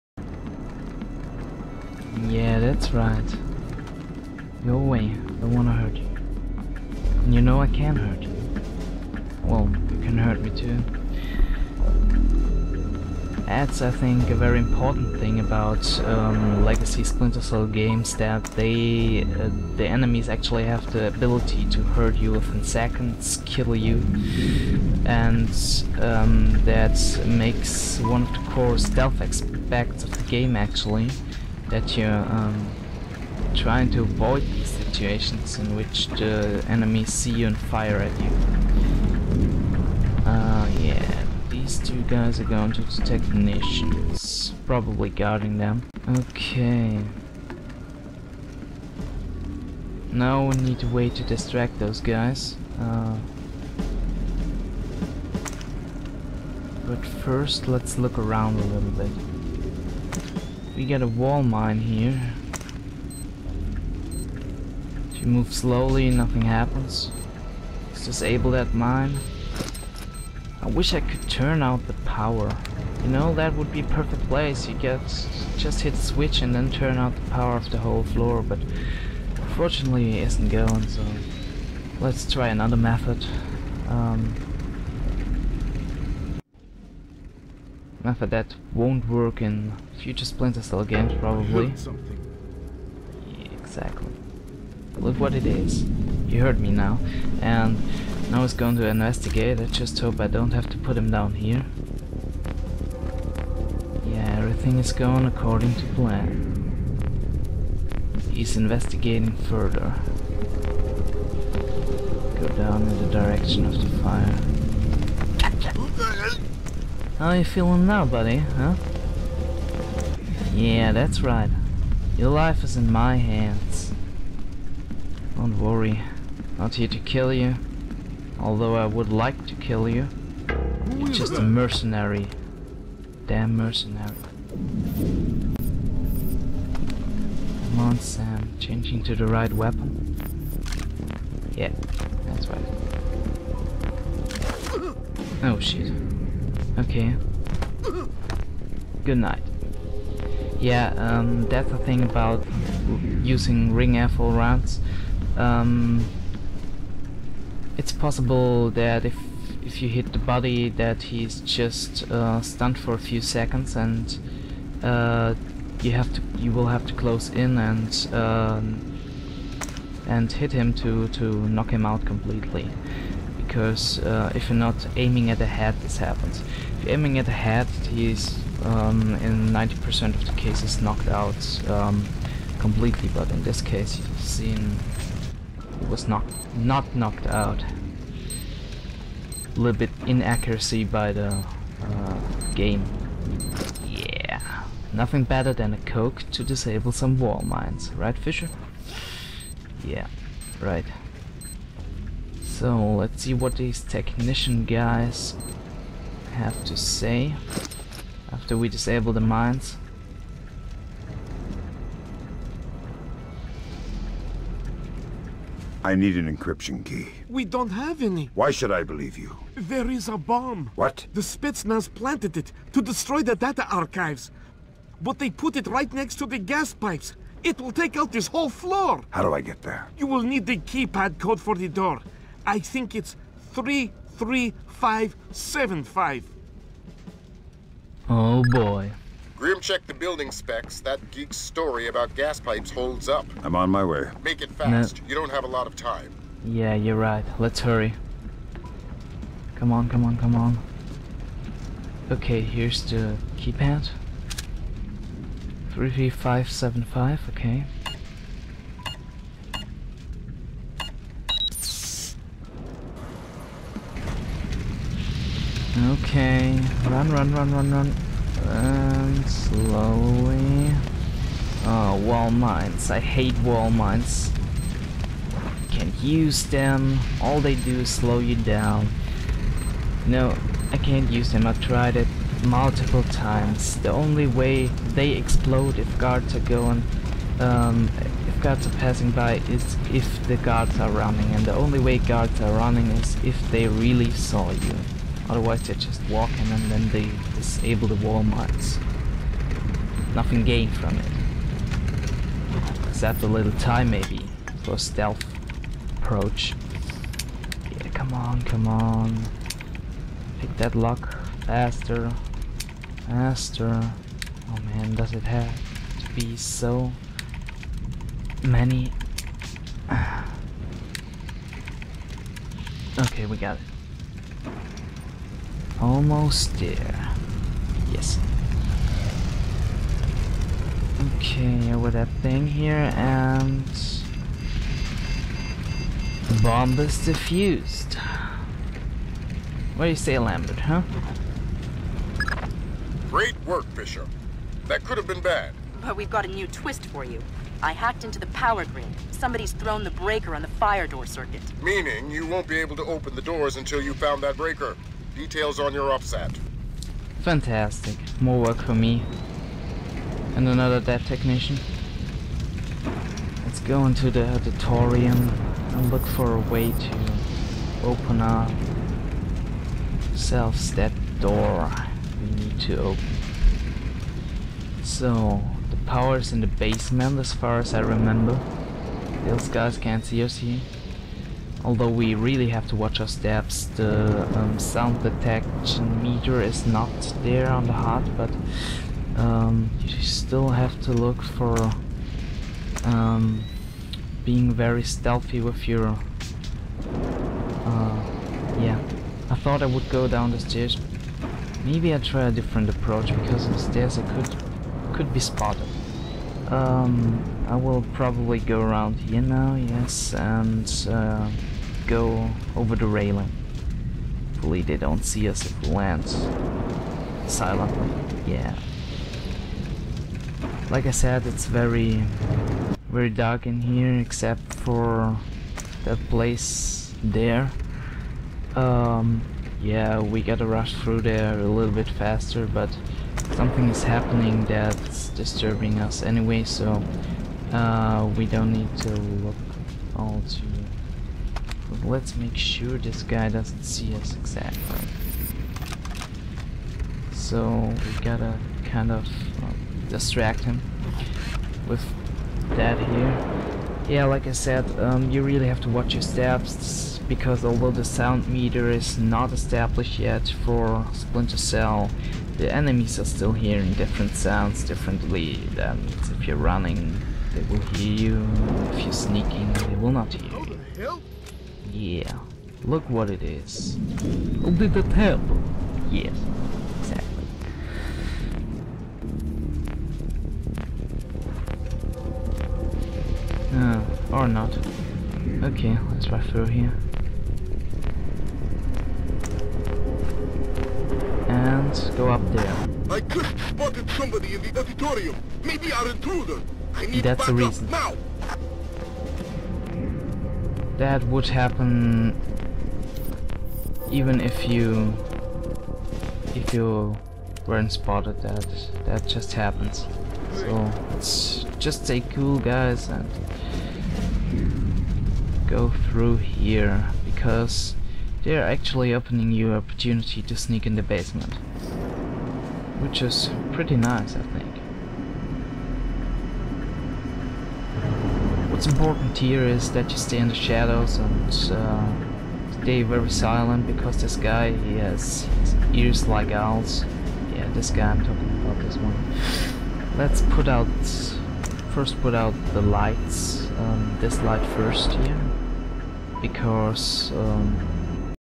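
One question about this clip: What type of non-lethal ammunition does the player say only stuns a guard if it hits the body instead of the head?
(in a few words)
ring airfoil rounds.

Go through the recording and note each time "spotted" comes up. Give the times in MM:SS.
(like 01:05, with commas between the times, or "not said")
06:45, 08:13, 08:27.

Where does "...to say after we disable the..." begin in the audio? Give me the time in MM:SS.
03:26.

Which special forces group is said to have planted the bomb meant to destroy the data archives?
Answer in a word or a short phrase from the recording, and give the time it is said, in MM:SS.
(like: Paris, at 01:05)
Spetsnaz, at 03:41.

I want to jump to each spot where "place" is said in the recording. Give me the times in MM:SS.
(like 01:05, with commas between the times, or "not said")
01:14, 07:06.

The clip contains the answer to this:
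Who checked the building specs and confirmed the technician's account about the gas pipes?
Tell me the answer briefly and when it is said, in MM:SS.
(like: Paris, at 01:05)
Grim, at 03:59.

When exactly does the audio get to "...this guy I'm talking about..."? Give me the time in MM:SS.
08:57.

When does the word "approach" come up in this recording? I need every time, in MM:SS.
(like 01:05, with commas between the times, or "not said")
05:05, 06:42.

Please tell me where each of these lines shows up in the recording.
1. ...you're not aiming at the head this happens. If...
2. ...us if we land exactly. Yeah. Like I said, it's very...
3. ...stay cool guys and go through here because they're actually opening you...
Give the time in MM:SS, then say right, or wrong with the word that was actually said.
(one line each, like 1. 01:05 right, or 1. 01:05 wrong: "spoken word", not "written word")
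1. 02:54 right
2. 06:55 wrong: "silently", not "exactly"
3. 08:31 right.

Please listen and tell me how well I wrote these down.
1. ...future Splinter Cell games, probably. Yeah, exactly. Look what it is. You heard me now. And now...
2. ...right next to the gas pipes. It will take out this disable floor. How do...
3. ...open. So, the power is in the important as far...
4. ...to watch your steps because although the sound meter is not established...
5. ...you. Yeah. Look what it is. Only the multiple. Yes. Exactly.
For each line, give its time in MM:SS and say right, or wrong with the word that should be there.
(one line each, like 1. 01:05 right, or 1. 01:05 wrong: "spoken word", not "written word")
1. 01:29 right
2. 03:45 wrong: "whole", not "disable"
3. 06:12 wrong: "basement", not "important"
4. 07:35 right
5. 07:50 wrong: "temple", not "multiple".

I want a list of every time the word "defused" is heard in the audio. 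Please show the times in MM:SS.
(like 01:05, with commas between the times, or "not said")
05:36.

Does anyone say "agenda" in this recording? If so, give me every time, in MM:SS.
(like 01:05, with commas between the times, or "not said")
not said.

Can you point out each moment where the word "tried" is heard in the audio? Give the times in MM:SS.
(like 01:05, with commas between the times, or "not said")
04:41.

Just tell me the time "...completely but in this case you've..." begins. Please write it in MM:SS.
03:02.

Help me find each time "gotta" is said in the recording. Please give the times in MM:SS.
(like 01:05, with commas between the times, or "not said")
07:10, 07:28.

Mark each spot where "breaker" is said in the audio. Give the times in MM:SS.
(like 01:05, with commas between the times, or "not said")
05:49, 05:54.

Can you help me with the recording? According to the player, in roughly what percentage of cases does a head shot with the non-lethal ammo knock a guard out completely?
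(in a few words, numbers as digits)
90%.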